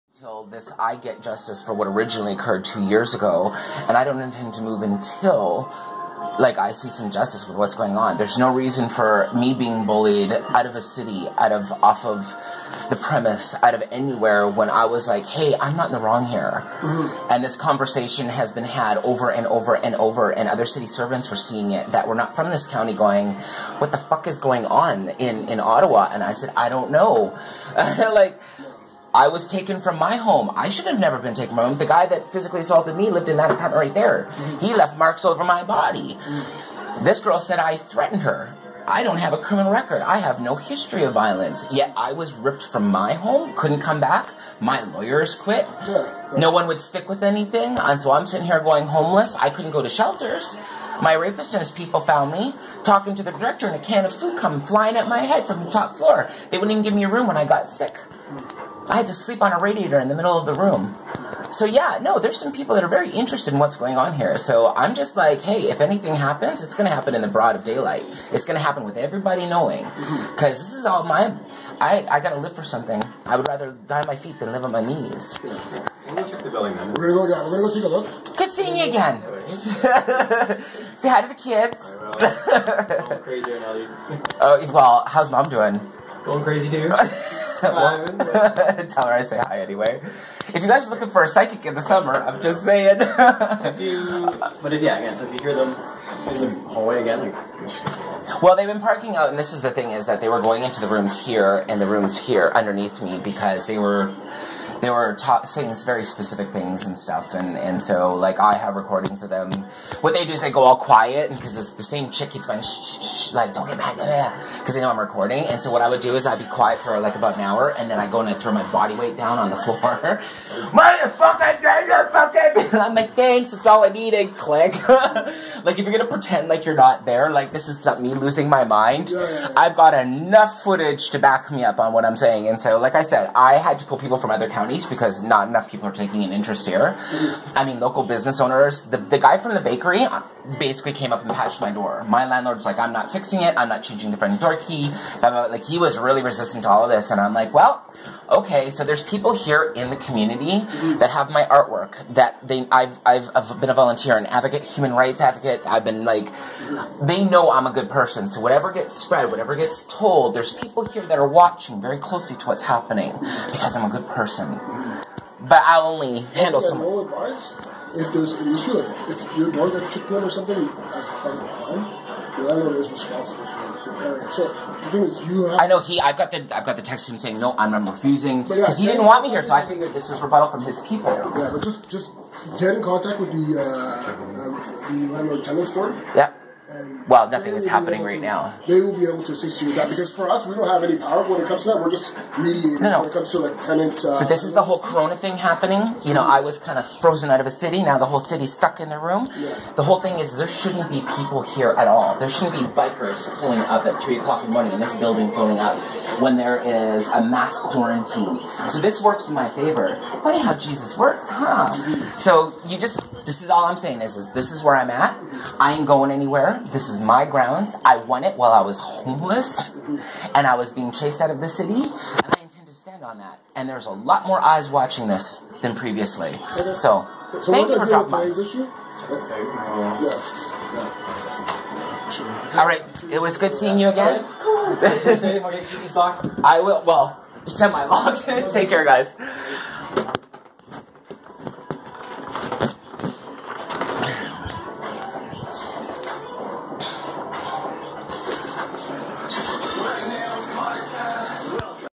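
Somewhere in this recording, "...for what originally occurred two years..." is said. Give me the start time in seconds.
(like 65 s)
1 s.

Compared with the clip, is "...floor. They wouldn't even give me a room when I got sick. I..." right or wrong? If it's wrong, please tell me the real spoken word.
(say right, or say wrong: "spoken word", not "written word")
right.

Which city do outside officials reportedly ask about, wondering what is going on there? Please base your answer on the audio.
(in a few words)
Ottawa.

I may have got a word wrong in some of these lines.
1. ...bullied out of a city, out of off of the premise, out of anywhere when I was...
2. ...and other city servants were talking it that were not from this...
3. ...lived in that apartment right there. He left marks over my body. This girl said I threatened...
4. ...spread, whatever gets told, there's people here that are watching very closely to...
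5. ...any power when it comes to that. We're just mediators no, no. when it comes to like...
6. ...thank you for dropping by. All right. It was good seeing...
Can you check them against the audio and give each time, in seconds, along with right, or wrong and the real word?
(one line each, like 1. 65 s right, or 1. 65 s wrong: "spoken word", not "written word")
1. 9 s right
2. 20 s wrong: "seeing", not "talking"
3. 33 s right
4. 158 s right
5. 190 s right
6. 227 s right.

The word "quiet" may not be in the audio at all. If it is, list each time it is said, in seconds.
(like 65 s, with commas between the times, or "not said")
110 s, 116 s.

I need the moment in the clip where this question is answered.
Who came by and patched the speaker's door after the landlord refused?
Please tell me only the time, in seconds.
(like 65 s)
139 s.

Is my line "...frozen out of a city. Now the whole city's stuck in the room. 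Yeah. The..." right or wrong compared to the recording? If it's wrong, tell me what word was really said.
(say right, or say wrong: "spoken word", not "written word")
right.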